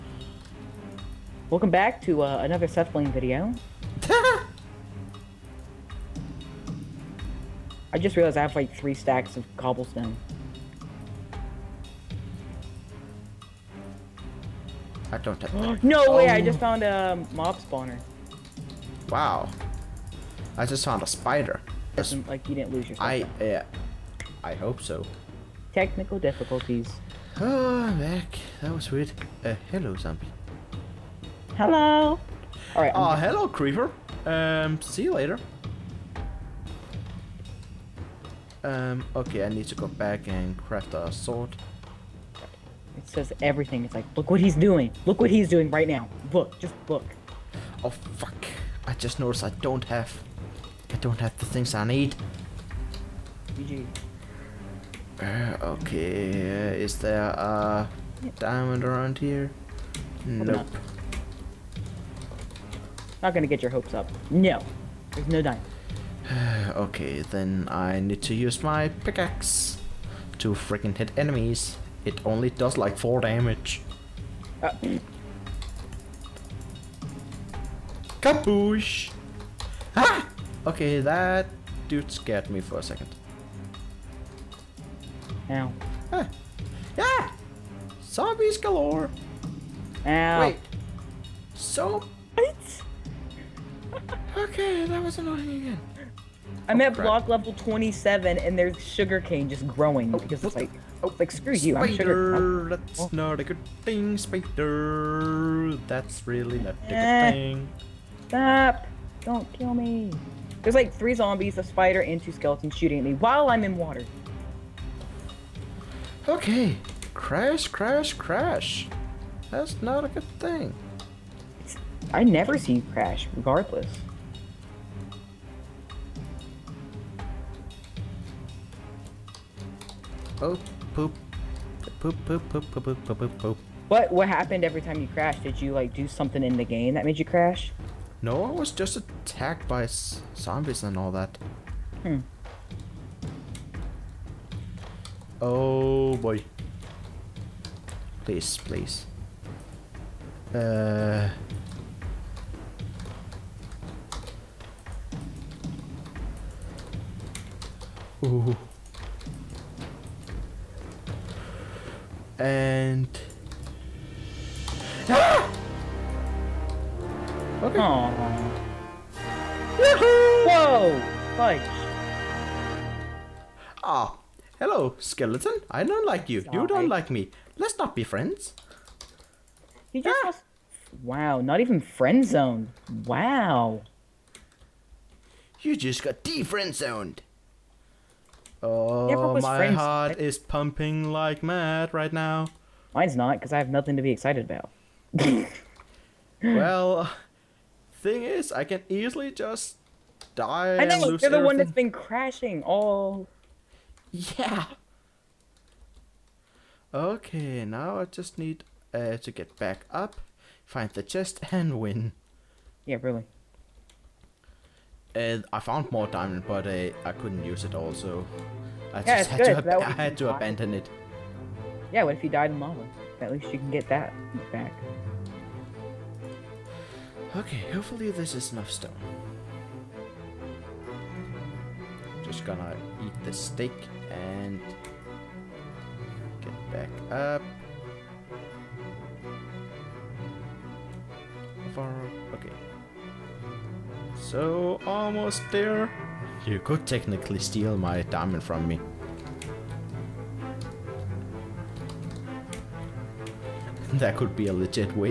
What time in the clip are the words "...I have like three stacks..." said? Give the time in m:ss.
0:08.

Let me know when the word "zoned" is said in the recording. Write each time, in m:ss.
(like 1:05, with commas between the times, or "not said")
3:02, 3:06.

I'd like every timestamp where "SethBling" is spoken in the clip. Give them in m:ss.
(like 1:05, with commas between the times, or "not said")
0:02.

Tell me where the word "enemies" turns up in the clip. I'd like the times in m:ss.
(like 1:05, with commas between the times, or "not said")
1:11.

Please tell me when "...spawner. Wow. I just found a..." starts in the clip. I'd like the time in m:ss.
0:17.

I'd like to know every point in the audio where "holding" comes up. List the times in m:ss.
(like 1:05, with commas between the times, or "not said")
not said.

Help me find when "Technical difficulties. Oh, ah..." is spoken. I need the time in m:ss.
0:25.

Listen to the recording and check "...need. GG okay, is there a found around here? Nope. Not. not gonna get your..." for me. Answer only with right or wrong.
wrong.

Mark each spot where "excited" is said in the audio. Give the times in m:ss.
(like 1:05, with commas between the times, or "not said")
3:14.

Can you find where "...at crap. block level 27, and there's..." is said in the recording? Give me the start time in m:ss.
1:36.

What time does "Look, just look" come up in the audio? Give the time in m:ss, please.
0:46.